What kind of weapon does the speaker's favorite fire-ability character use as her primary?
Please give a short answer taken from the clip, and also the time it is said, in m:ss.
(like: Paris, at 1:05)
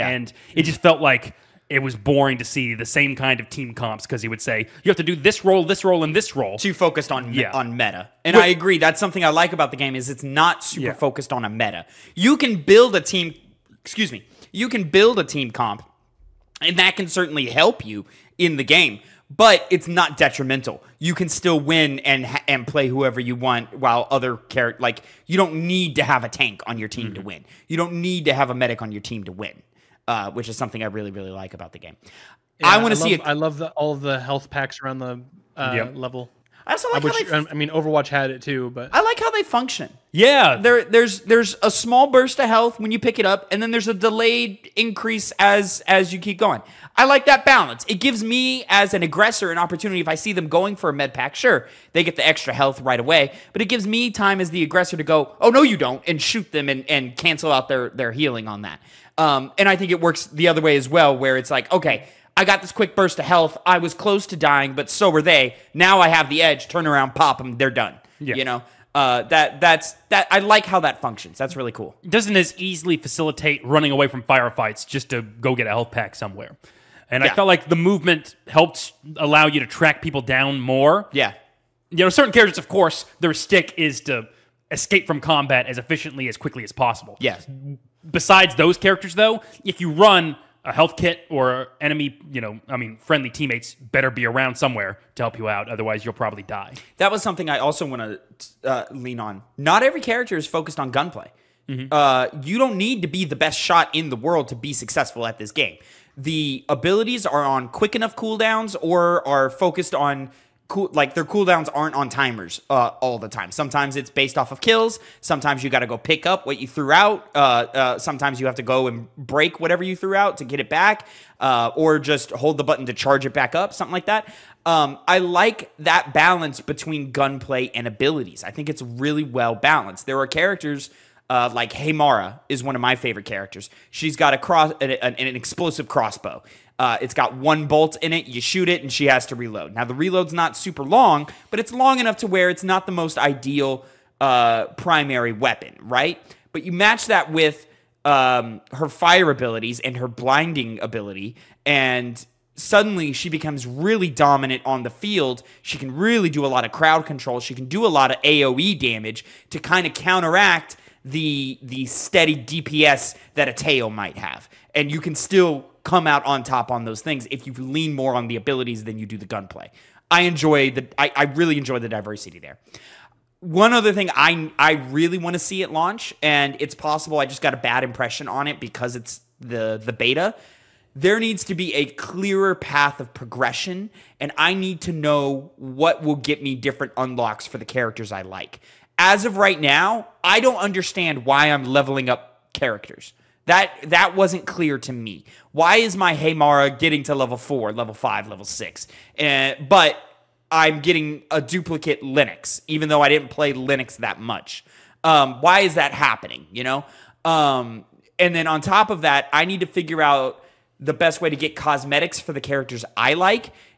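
Explosive crossbow, at 2:15.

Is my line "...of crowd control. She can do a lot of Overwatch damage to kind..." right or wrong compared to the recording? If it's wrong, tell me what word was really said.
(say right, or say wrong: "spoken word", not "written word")
wrong: "AoE", not "Overwatch".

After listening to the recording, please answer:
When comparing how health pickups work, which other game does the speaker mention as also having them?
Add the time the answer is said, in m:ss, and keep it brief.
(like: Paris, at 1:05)
Overwatch, at 0:37.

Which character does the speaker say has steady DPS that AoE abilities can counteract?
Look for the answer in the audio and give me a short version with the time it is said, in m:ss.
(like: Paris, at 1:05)
Teo, at 2:43.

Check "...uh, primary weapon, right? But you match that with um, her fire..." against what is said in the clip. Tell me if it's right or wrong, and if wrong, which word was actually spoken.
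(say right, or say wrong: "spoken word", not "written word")
right.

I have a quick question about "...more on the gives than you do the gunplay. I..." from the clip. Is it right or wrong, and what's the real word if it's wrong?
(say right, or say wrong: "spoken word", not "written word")
wrong: "abilities", not "gives".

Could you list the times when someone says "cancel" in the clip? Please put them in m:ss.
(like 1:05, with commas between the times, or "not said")
0:57.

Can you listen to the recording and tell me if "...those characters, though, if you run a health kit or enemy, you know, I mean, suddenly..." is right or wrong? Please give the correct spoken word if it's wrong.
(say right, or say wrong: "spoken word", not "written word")
wrong: "friendly", not "suddenly".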